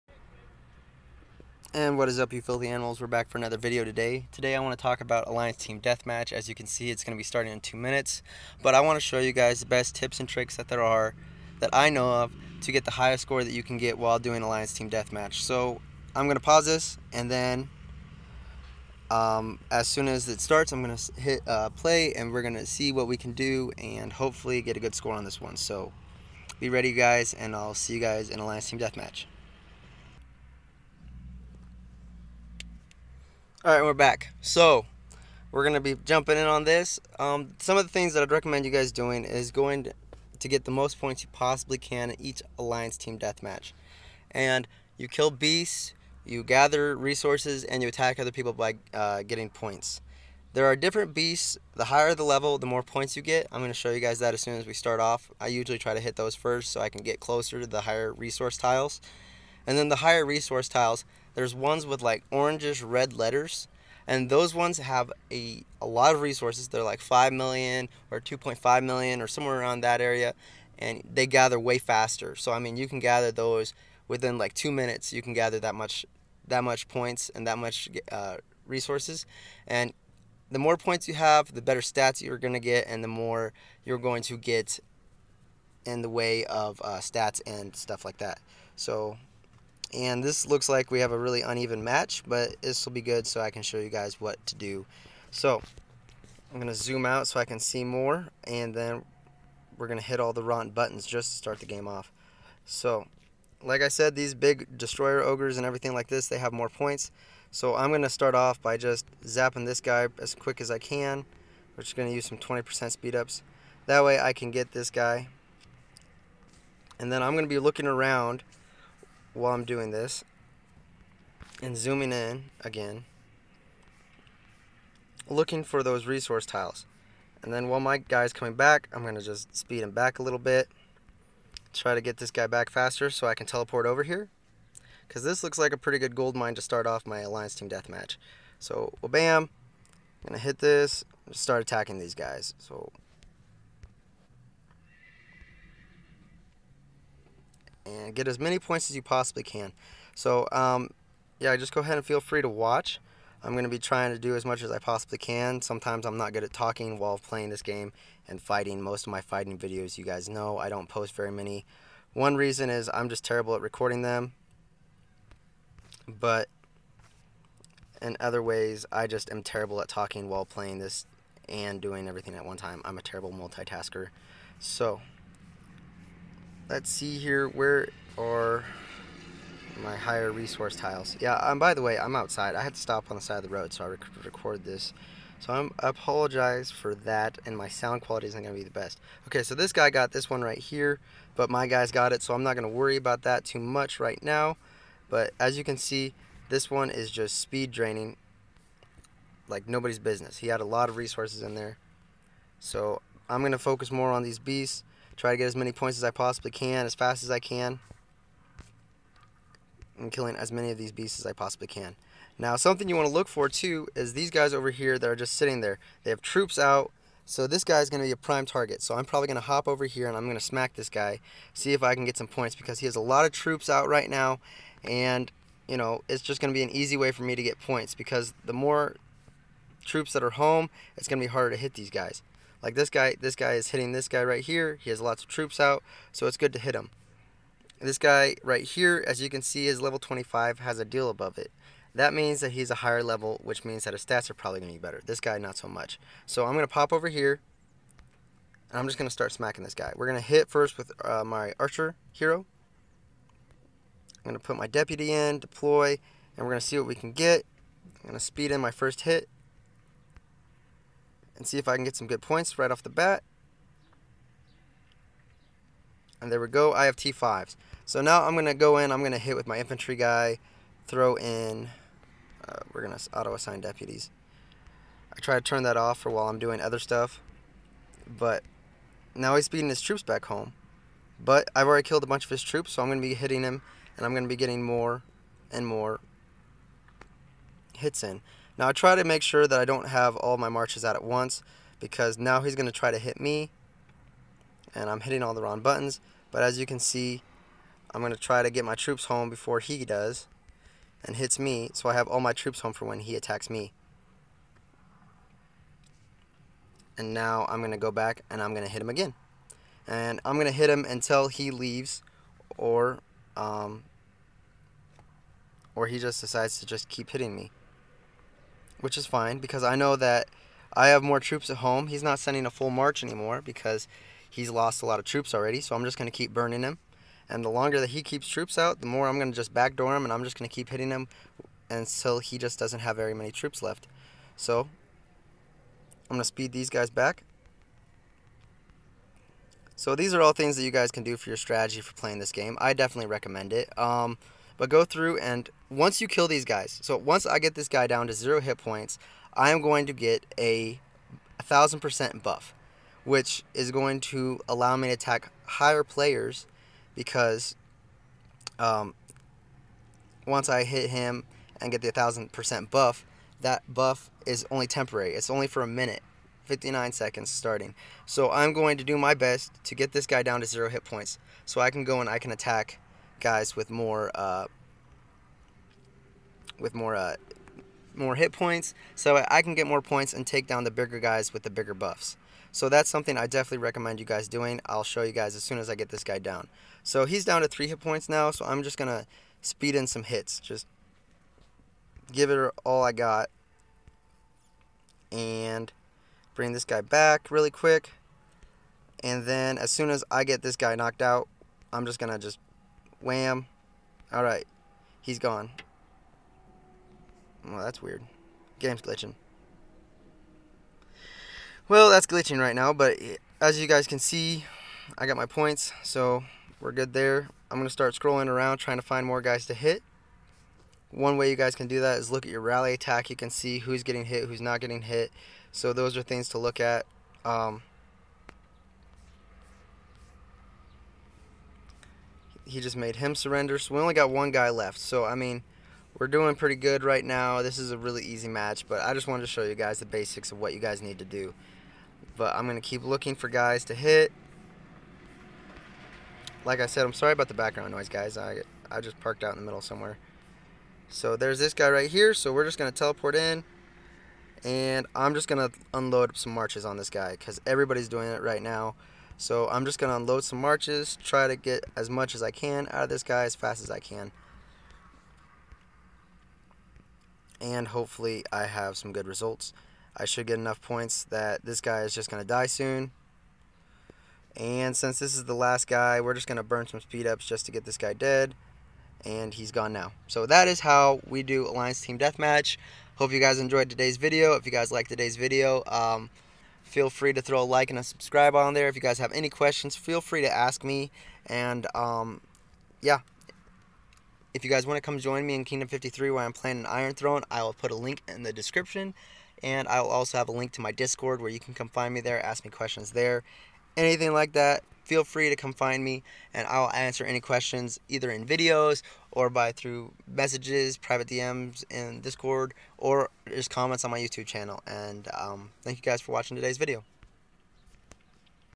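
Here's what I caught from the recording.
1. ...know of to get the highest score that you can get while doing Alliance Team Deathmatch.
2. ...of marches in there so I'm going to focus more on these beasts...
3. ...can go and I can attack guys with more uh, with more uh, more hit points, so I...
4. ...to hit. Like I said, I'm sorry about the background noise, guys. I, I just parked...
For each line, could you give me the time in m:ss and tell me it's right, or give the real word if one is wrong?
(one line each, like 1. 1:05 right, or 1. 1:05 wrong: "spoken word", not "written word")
1. 0:11 right
2. 3:20 wrong: "resources", not "marches"
3. 6:11 right
4. 7:23 right.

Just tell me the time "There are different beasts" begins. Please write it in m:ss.
0:50.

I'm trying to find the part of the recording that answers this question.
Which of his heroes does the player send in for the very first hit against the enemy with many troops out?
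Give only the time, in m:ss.
4:11.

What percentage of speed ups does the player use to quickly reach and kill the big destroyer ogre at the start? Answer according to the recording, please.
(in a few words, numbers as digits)
20%.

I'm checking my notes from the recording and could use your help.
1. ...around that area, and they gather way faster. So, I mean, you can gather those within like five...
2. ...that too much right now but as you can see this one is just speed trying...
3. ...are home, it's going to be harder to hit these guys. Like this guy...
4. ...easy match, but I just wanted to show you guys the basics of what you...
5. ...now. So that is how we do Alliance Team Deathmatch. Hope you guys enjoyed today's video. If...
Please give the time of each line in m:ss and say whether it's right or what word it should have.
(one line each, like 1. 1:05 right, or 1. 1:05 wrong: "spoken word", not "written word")
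1. 1:09 wrong: "two", not "five"
2. 3:13 wrong: "draining", not "trying"
3. 3:50 right
4. 7:18 right
5. 7:59 right.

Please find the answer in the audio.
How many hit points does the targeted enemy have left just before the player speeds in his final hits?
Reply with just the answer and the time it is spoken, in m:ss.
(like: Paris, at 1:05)
3, at 6:27.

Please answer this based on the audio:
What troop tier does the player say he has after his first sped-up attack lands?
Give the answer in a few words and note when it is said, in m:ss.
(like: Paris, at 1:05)
T5, at 4:26.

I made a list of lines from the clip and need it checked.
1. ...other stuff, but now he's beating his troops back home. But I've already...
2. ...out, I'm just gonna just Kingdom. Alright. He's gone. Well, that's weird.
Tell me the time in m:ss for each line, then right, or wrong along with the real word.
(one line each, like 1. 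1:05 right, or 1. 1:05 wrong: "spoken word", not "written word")
1. 4:36 right
2. 6:41 wrong: "Wham", not "Kingdom".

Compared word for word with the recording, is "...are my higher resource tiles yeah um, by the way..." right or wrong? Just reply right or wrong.
right.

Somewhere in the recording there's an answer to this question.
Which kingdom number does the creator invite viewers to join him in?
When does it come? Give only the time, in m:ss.
8:15.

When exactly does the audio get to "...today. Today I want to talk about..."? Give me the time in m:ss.
0:03.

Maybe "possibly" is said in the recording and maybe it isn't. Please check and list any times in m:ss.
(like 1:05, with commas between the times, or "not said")
0:41, 2:29, 2:34, 3:26, 3:31.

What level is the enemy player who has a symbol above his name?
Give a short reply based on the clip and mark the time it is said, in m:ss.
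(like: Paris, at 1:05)
25, at 3:59.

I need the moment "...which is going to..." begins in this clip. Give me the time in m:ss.
5:53.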